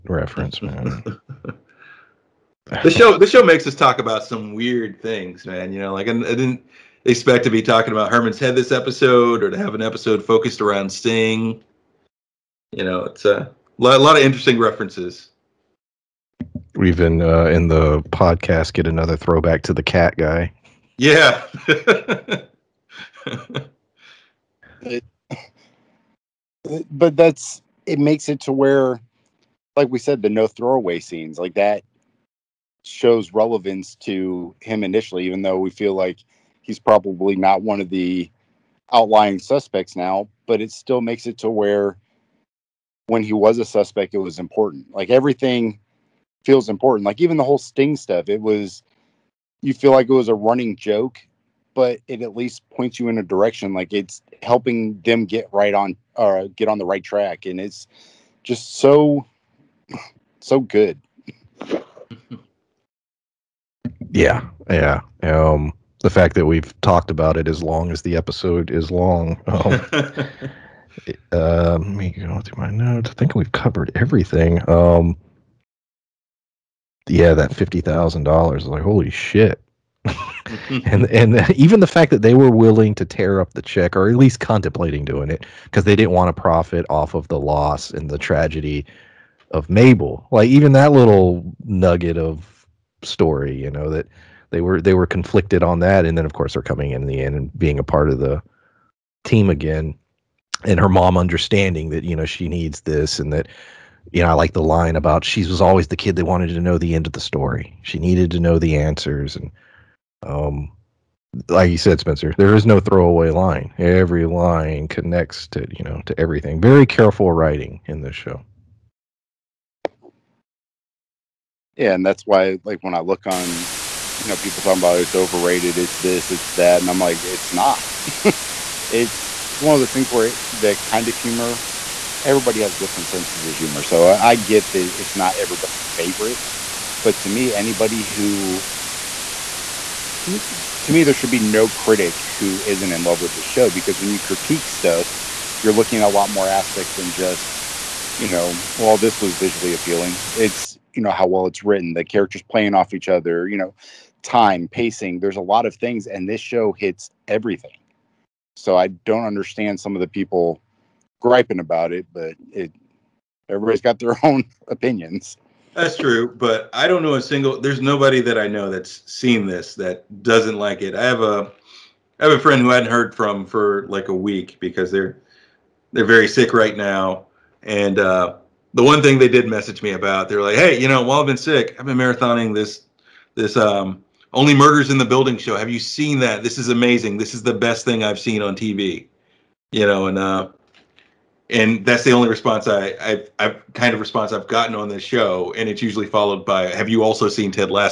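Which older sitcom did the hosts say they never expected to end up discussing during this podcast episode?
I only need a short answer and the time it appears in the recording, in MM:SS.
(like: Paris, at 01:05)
Herman's Head, at 00:08.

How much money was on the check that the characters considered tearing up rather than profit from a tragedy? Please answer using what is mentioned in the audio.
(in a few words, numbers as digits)
$50,000.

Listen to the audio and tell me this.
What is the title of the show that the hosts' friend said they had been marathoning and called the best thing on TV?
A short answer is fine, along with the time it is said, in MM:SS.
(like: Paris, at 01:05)
Only Murders in the Building, at 03:04.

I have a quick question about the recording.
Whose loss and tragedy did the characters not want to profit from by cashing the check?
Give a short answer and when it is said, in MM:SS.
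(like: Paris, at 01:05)
Mabel, at 01:29.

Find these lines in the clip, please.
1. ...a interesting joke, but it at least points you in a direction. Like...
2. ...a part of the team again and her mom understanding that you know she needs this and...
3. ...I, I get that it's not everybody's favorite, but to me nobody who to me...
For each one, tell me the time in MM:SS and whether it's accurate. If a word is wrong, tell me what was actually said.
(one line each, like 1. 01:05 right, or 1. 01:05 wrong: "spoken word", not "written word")
1. 00:50 wrong: "running", not "interesting"
2. 01:37 right
3. 02:14 wrong: "anybody", not "nobody".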